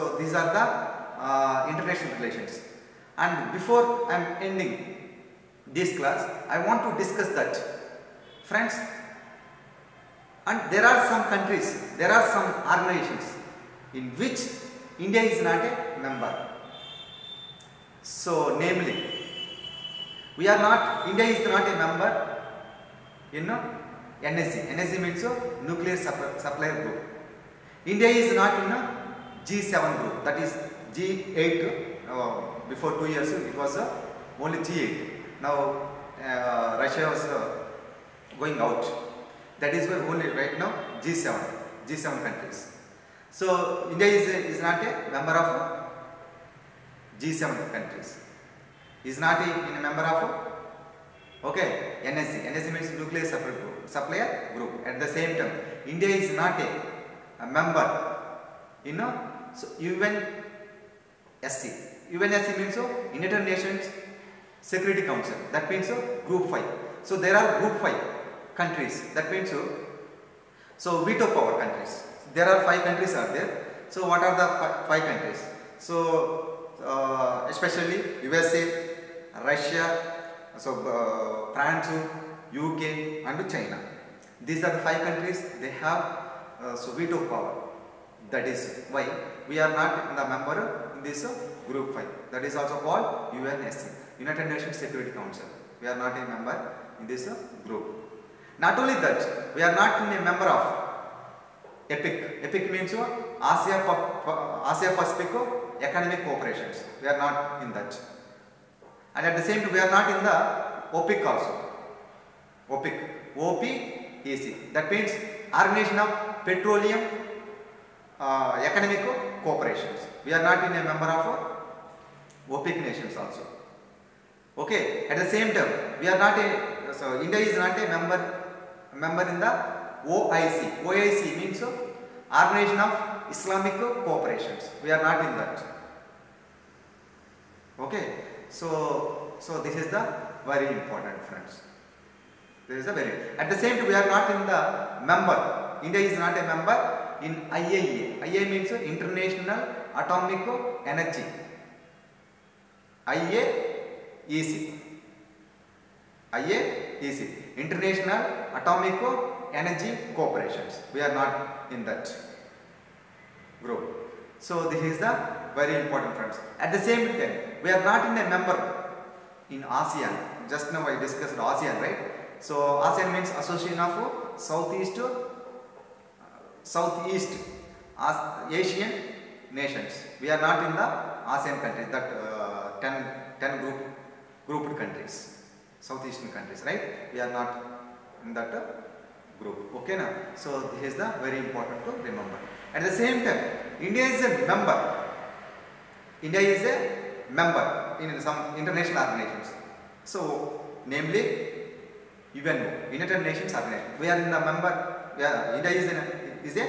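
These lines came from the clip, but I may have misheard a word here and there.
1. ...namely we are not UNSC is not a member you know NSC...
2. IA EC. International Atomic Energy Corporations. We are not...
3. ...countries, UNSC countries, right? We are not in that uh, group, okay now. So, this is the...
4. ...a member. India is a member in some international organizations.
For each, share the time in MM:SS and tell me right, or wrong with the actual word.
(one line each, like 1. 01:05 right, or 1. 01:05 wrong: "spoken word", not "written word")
1. 00:18 wrong: "India", not "UNSC"
2. 02:36 right
3. 03:04 wrong: "South", not "UNSC"
4. 03:14 right.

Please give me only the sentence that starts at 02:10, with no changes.
OIC means uh, Organization of Islamic Cooperations.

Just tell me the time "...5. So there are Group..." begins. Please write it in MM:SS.
01:06.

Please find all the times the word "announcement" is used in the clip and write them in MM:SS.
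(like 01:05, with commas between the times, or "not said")
not said.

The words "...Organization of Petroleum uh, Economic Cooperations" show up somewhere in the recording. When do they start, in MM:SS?
01:55.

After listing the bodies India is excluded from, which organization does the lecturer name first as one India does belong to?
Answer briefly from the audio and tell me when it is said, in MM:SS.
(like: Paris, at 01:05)
United Nations Organization, at 03:22.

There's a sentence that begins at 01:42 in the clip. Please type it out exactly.
EPIC means uh, Asia, Asia Pacific uh, Economic Cooperations.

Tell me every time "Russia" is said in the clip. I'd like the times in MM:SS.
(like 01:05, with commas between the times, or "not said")
00:36, 01:19.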